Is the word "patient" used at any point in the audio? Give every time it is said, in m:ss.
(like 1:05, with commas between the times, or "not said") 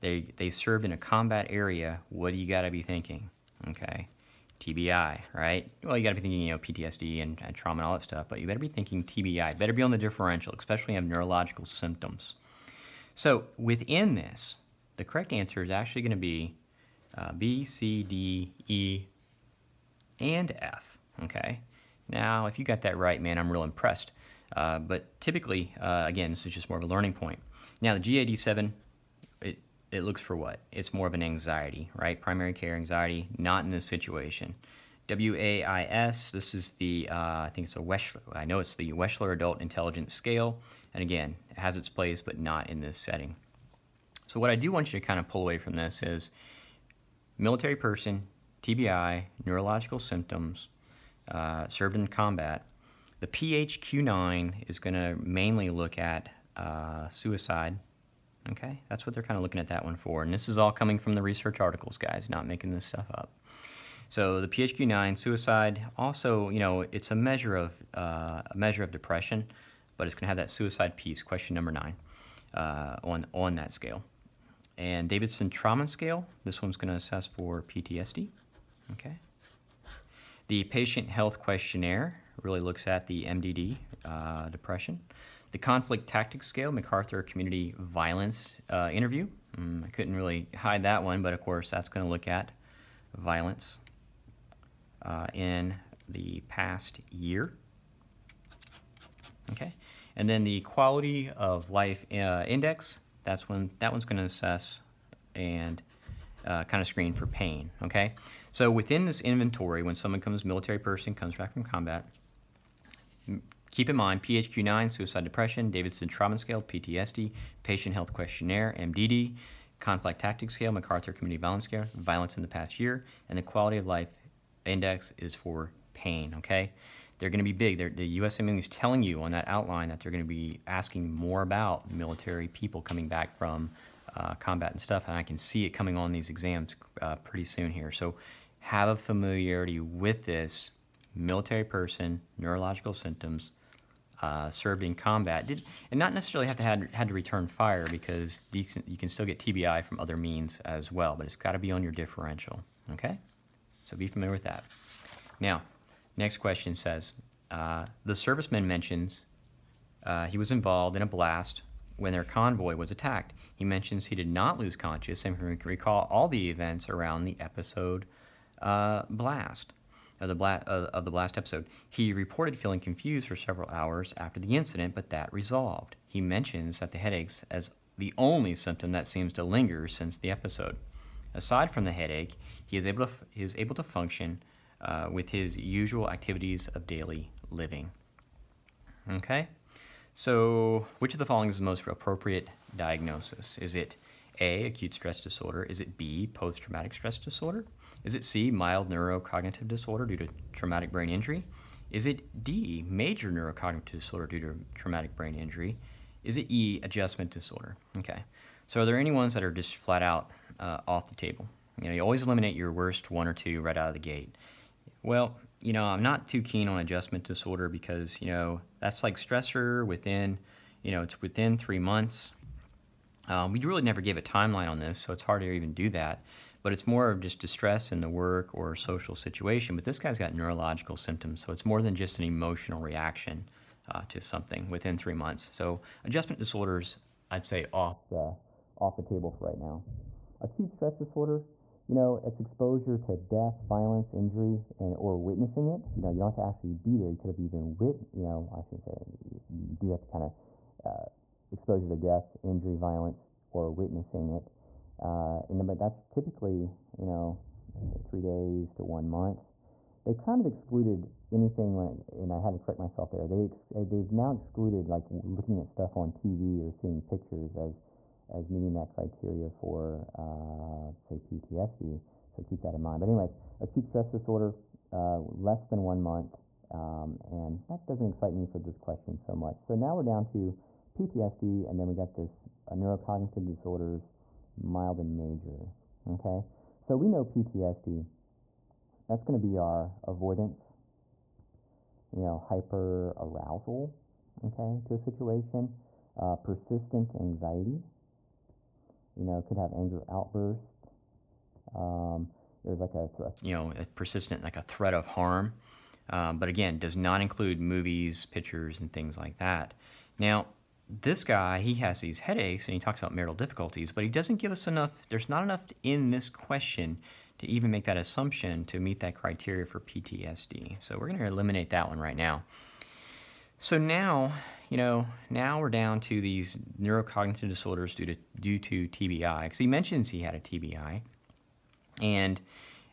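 1:20, 1:57.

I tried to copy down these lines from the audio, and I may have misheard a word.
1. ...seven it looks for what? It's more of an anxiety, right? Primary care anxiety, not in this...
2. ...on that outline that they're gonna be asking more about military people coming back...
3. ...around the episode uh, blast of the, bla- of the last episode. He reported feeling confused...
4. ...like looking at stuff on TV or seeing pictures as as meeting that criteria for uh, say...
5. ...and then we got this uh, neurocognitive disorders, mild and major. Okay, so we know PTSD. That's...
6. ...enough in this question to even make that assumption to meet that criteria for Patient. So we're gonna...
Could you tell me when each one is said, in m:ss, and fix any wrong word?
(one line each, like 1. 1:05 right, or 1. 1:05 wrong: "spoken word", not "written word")
1. 0:28 right
2. 2:09 right
3. 2:46 right
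4. 4:24 right
5. 4:41 right
6. 5:15 wrong: "PTSD", not "Patient".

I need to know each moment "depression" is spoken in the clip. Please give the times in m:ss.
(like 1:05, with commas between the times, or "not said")
1:08, 1:24, 1:55.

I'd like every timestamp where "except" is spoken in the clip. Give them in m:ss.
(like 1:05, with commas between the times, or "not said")
not said.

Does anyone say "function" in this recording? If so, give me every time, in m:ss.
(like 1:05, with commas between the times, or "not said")
3:03.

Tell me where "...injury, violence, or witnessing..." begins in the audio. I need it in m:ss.
4:12.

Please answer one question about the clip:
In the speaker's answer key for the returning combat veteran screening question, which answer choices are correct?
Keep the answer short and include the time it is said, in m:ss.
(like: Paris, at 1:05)
B, C, D, E, and F, at 0:17.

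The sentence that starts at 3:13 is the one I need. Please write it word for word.
Is it a, acute stress disorder?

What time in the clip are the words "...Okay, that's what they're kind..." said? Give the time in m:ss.
0:58.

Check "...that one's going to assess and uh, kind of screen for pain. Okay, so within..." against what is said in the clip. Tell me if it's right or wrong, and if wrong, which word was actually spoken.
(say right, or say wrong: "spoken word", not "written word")
right.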